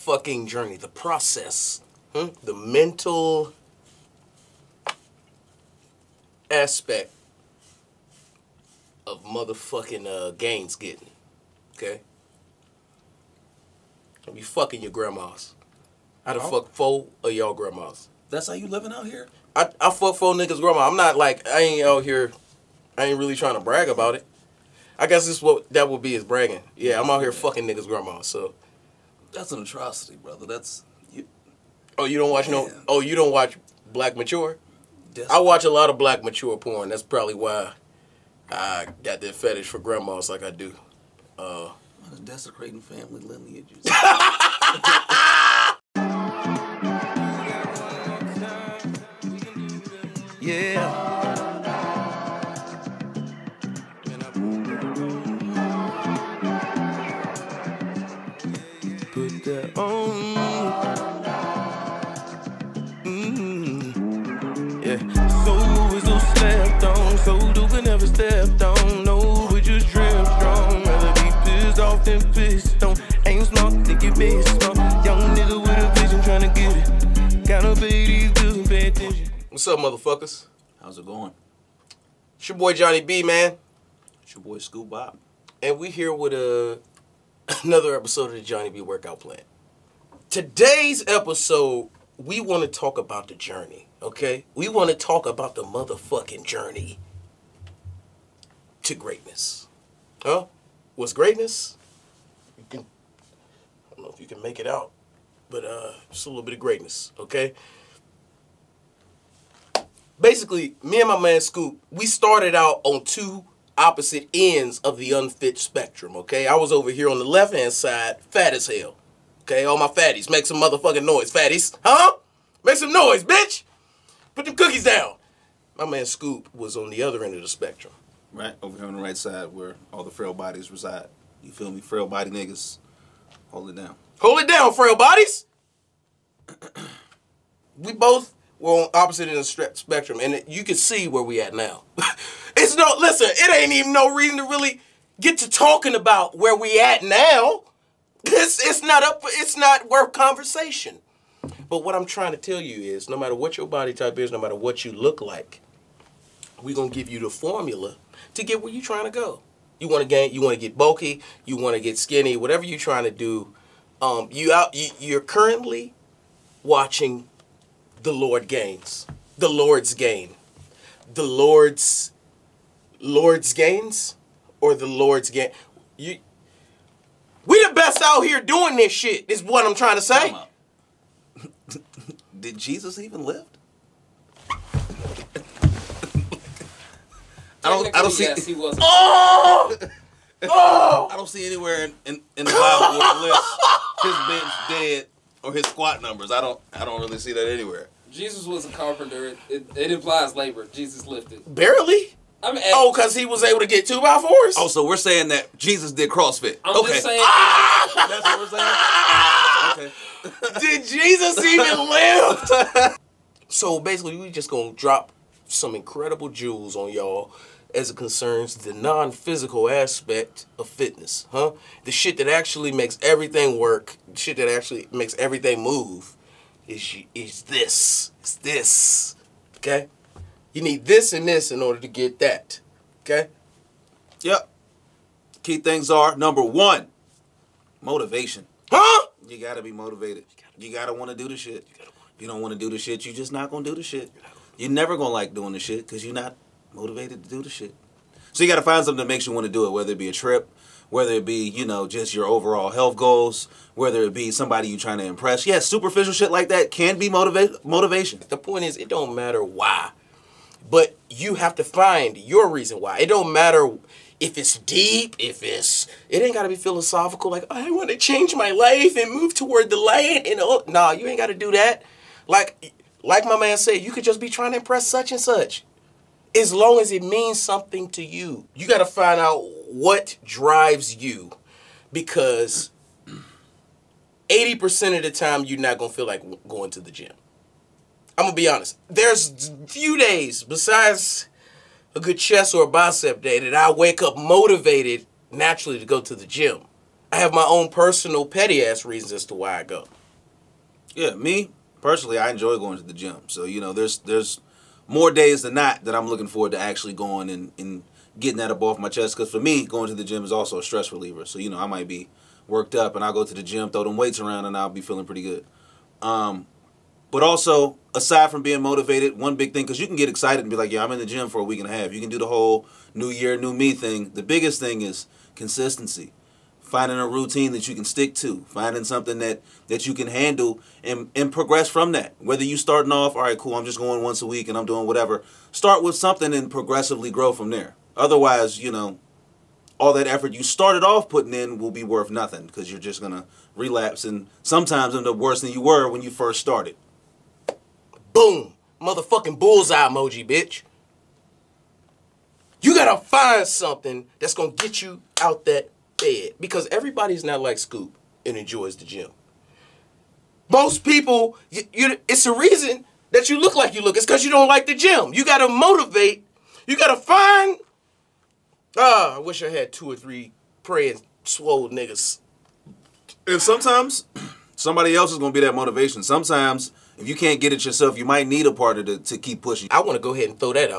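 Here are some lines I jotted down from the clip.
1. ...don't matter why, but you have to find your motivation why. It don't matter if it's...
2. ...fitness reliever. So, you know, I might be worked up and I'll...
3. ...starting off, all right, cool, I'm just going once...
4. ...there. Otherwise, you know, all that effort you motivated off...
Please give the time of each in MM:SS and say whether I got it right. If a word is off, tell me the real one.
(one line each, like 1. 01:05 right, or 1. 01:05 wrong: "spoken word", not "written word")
1. 04:18 wrong: "reason", not "motivation"
2. 05:10 wrong: "stress", not "fitness"
3. 05:32 right
4. 05:37 wrong: "started", not "motivated".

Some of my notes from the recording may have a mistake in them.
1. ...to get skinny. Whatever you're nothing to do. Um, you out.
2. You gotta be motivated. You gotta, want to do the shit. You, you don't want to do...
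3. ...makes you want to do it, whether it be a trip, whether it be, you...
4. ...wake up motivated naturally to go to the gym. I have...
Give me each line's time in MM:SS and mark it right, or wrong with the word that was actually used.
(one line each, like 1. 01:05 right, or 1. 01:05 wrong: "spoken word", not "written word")
1. 02:41 wrong: "trying", not "nothing"
2. 03:59 right
3. 04:09 right
4. 04:53 right.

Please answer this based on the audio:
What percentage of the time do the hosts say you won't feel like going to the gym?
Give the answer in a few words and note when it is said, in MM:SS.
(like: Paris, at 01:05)
80%, at 04:44.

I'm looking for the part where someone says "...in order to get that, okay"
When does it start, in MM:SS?
03:51.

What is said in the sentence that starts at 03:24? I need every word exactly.
Oh, so we're saying that Jesus did CrossFit.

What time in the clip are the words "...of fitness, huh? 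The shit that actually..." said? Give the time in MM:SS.
03:40.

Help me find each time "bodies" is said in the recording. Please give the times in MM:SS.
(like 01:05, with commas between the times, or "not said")
02:10, 02:14.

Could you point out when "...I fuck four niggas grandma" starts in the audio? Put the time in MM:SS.
00:19.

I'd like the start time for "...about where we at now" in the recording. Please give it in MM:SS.
02:25.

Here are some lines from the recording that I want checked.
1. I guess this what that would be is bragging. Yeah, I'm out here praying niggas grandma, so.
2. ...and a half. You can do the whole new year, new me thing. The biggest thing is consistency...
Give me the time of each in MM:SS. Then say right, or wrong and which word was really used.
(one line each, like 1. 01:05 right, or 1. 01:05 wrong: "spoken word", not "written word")
1. 00:24 wrong: "fucking", not "praying"
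2. 05:21 right.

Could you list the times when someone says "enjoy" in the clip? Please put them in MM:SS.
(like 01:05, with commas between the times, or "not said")
05:02, 05:58.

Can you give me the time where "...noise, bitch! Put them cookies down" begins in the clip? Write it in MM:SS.
02:02.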